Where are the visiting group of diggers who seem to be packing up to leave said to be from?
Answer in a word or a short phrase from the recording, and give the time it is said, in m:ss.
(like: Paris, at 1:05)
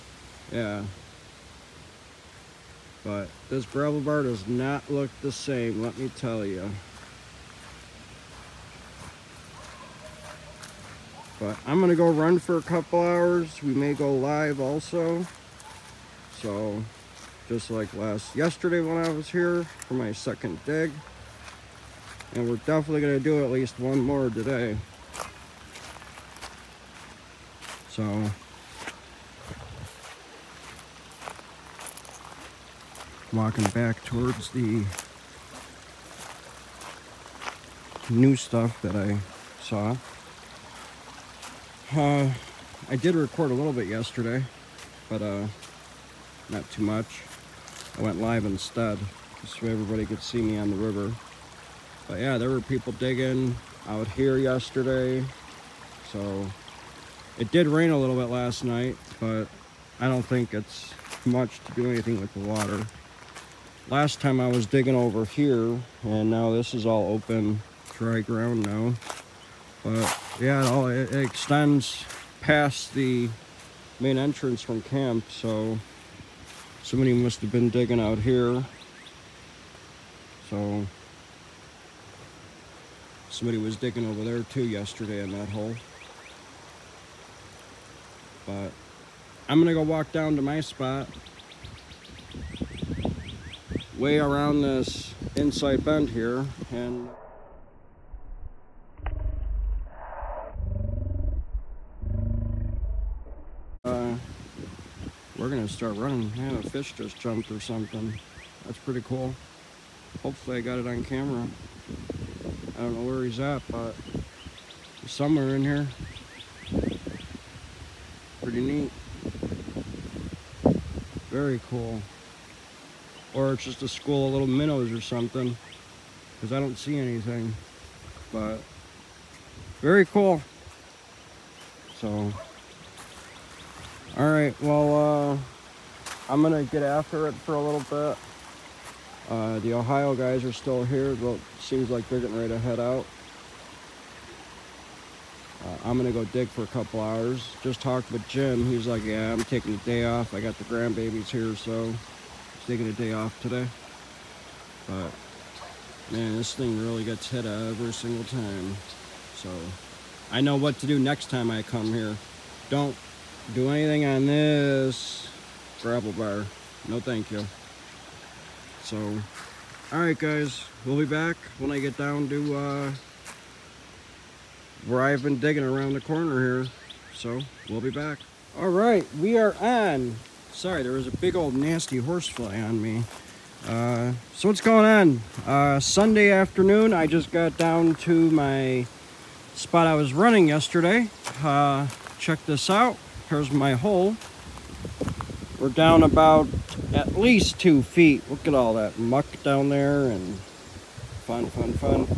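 Ohio, at 2:19.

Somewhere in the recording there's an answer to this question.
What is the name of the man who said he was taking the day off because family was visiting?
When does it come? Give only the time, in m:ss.
2:28.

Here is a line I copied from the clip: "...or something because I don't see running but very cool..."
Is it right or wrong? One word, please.
wrong.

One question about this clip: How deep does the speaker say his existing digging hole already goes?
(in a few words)
2 feet.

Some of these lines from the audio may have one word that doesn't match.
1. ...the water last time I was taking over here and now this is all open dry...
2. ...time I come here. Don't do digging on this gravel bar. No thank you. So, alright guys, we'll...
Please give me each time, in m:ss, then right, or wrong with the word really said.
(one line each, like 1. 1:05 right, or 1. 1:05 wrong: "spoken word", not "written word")
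1. 1:02 wrong: "digging", not "taking"
2. 2:41 wrong: "anything", not "digging".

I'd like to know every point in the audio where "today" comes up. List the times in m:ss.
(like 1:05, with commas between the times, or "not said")
0:24, 2:33.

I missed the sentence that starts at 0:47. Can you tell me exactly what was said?
I went live instead, so everybody could see me on the river.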